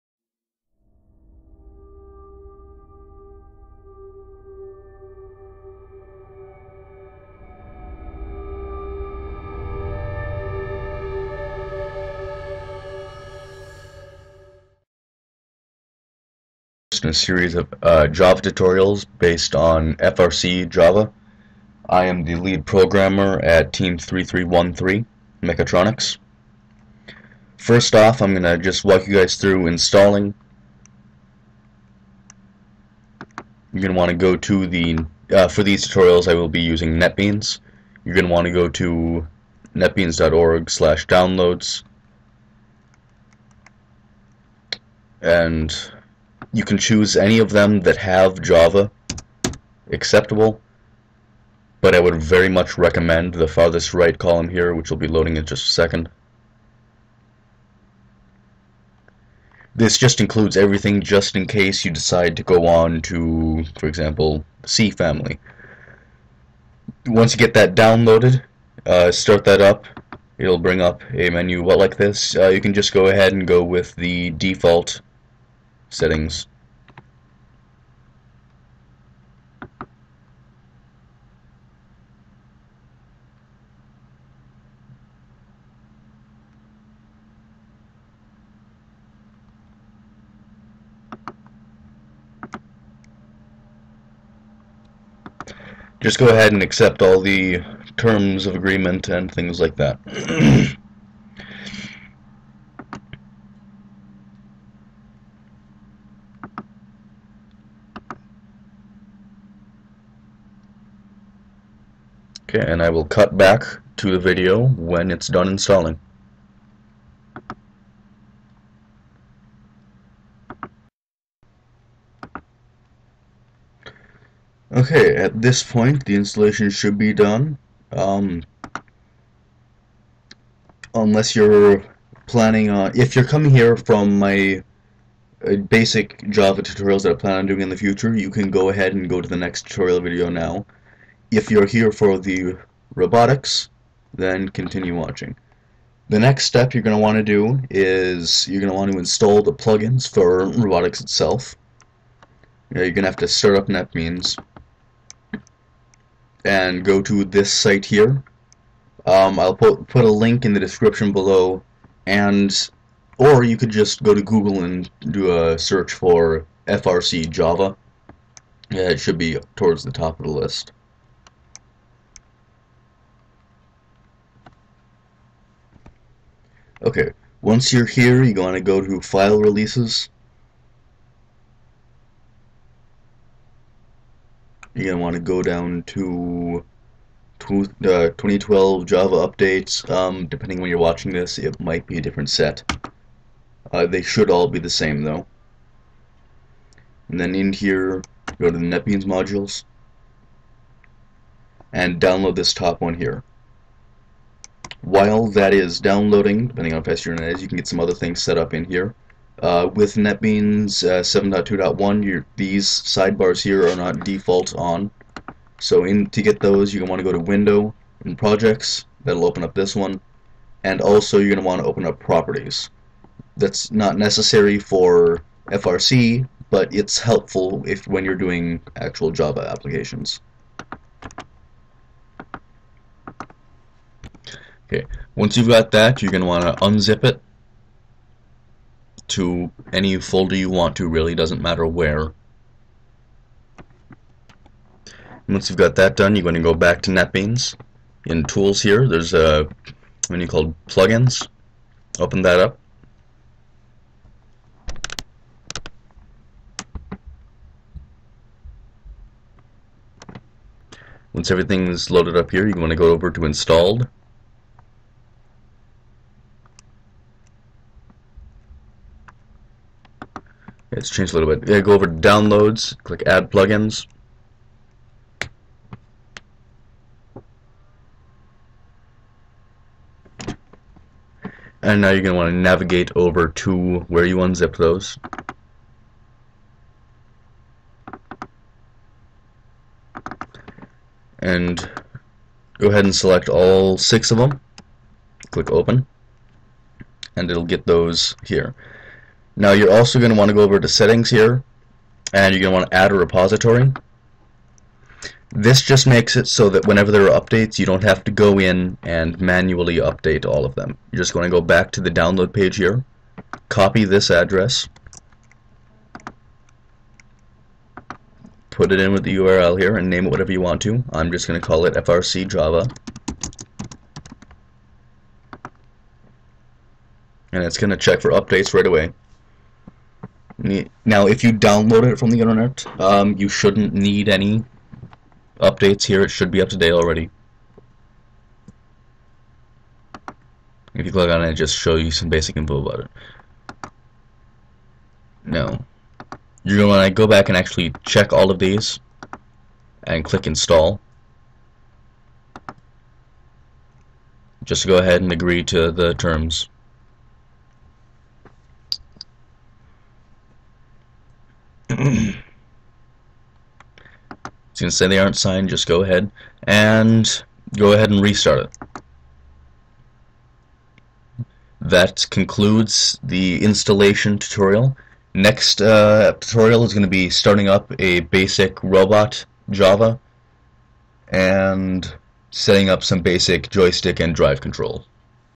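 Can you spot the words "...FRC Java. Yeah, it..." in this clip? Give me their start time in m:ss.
2:46.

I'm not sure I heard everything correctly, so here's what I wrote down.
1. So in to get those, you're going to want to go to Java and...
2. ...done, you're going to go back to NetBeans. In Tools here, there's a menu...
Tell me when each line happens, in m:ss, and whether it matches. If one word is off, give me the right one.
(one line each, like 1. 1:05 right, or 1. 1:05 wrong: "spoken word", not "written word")
1. 3:35 wrong: "Window", not "Java"
2. 4:05 right.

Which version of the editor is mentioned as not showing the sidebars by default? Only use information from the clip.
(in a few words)
7.2.1.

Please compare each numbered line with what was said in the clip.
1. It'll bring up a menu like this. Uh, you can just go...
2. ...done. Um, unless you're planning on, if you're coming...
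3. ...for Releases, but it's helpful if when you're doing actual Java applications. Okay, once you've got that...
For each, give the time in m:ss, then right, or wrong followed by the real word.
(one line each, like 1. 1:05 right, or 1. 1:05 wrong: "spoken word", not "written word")
1. 1:10 right
2. 2:07 right
3. 3:44 wrong: "FRC", not "Releases".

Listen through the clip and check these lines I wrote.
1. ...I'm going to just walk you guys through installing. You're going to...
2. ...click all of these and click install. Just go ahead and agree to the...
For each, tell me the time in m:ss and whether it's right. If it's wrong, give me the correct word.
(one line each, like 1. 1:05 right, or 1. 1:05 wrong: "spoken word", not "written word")
1. 0:28 right
2. 5:47 wrong: "check", not "click".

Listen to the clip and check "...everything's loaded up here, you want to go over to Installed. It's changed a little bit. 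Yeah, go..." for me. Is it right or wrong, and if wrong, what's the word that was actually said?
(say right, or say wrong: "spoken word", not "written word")
right.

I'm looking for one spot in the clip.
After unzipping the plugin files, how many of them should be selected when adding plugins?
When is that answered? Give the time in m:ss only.
4:53.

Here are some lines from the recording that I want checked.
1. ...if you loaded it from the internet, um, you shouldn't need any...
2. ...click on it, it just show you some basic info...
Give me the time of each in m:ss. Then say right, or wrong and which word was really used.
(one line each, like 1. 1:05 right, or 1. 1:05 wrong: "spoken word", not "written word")
1. 5:31 wrong: "downloaded", not "loaded"
2. 5:40 right.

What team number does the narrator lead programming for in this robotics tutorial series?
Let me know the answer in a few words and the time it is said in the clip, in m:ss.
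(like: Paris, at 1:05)
3313, at 0:23.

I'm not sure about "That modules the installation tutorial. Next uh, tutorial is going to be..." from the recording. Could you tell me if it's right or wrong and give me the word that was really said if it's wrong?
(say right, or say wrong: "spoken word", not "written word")
wrong: "concludes", not "modules".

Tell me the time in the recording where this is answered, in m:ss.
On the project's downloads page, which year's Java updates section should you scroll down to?
3:07.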